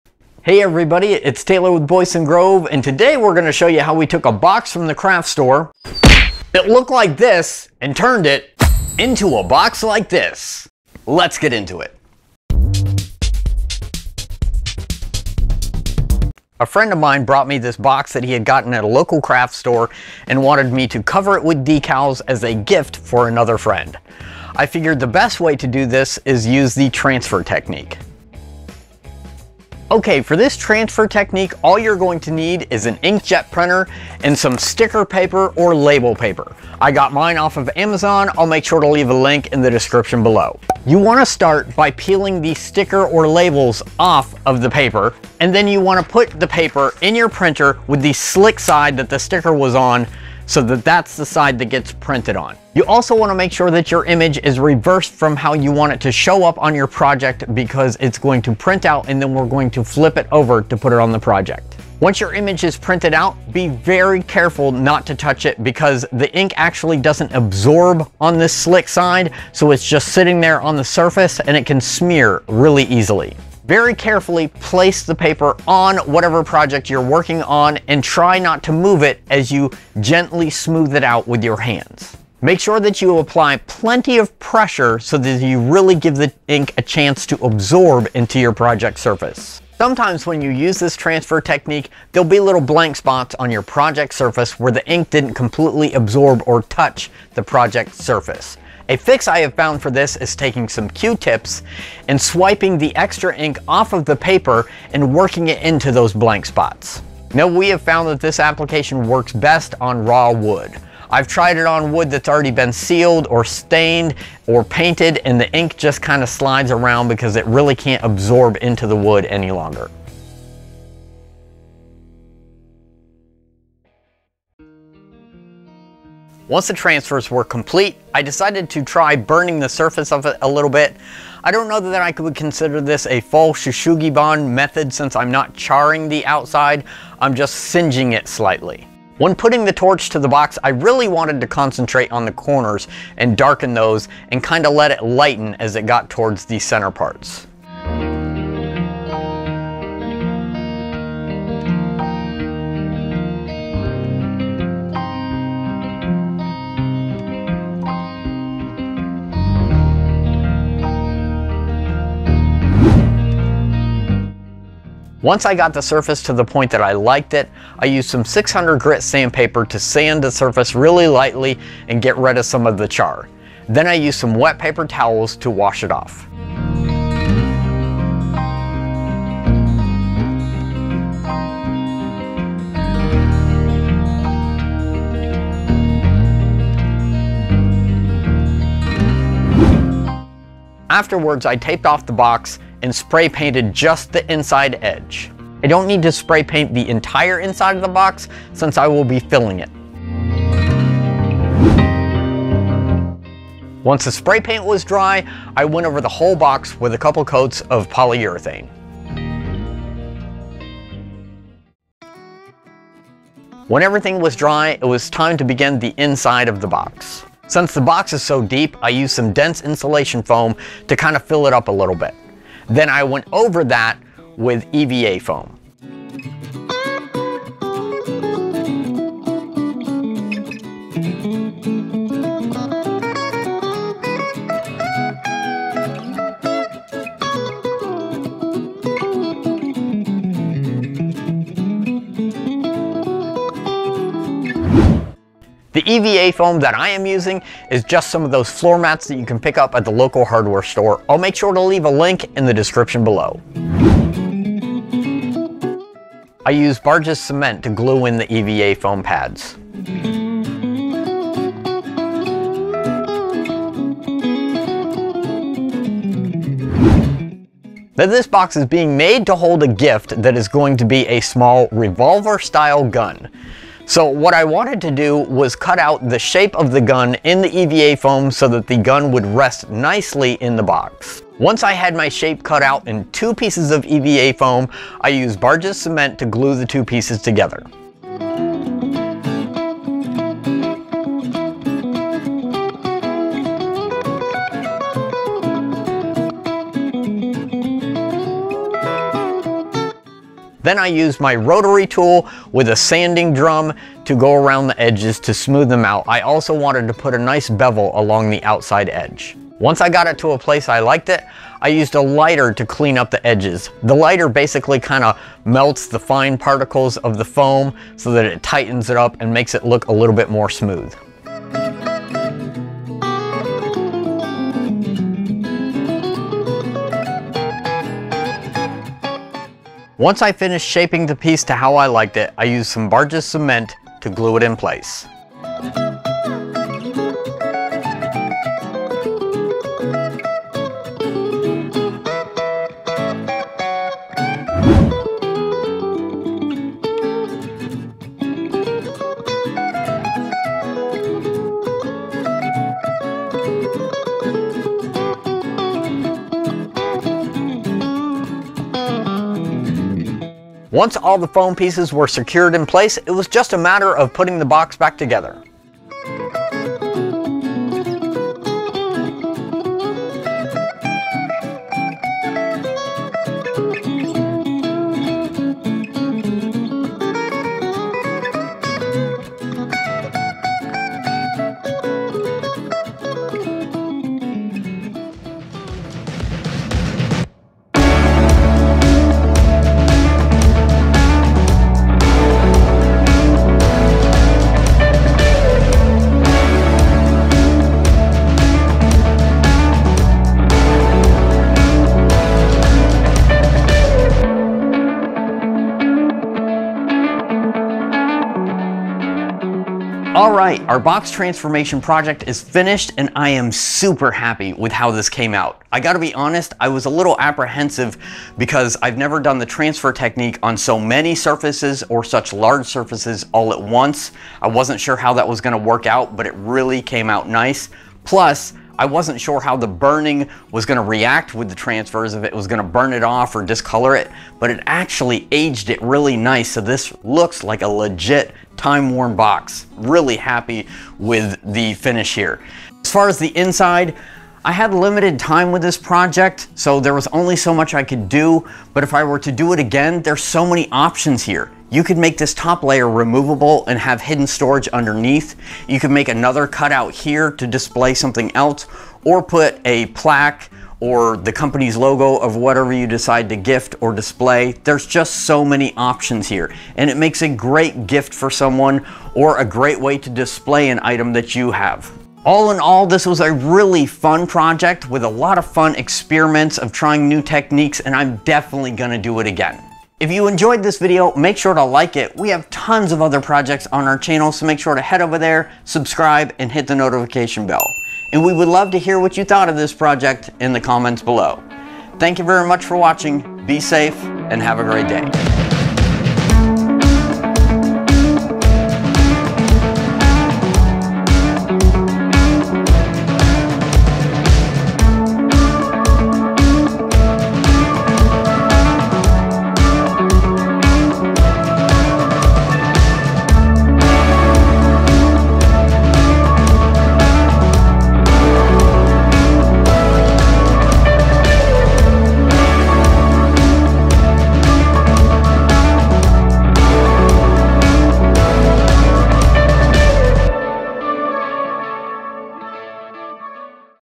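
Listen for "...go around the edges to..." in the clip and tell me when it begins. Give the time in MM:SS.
05:04.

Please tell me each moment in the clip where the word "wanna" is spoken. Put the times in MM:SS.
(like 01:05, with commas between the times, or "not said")
00:40, 00:45, 00:53.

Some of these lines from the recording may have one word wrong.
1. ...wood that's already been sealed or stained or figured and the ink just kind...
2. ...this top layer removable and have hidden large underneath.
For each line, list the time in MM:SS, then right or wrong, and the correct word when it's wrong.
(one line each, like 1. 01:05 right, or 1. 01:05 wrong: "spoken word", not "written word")
1. 01:51 wrong: "painted", not "figured"
2. 07:32 wrong: "storage", not "large".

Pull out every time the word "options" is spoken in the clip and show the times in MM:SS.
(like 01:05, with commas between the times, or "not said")
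07:30, 07:45.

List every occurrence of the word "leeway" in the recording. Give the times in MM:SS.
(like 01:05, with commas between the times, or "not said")
not said.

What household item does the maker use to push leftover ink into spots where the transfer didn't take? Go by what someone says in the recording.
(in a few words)
Q-tips.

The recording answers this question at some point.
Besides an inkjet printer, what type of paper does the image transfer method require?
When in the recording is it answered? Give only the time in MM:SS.
00:34.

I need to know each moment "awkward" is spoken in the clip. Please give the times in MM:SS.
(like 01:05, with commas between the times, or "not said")
not said.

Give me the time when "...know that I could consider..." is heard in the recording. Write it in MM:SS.
02:11.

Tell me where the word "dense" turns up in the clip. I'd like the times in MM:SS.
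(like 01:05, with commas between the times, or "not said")
03:39.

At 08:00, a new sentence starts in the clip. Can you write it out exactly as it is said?
If you enjoyed this video, make sure to like it.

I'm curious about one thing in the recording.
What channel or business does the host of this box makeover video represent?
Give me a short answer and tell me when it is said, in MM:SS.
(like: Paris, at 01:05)
Boydston Grove, at 00:01.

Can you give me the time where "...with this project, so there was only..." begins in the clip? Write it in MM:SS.
07:25.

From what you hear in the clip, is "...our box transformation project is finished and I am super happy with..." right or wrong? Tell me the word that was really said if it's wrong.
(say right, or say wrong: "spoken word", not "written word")
right.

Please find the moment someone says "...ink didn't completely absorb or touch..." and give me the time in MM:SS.
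01:34.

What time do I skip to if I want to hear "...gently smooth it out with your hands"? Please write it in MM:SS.
01:20.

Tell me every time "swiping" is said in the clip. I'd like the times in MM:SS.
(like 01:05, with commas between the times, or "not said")
01:42.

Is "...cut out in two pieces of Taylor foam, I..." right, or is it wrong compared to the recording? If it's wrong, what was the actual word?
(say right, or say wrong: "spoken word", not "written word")
wrong: "EVA", not "Taylor".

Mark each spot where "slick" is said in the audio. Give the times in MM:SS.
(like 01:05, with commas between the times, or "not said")
00:48, 01:08.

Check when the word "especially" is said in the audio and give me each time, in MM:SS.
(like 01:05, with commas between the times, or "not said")
not said.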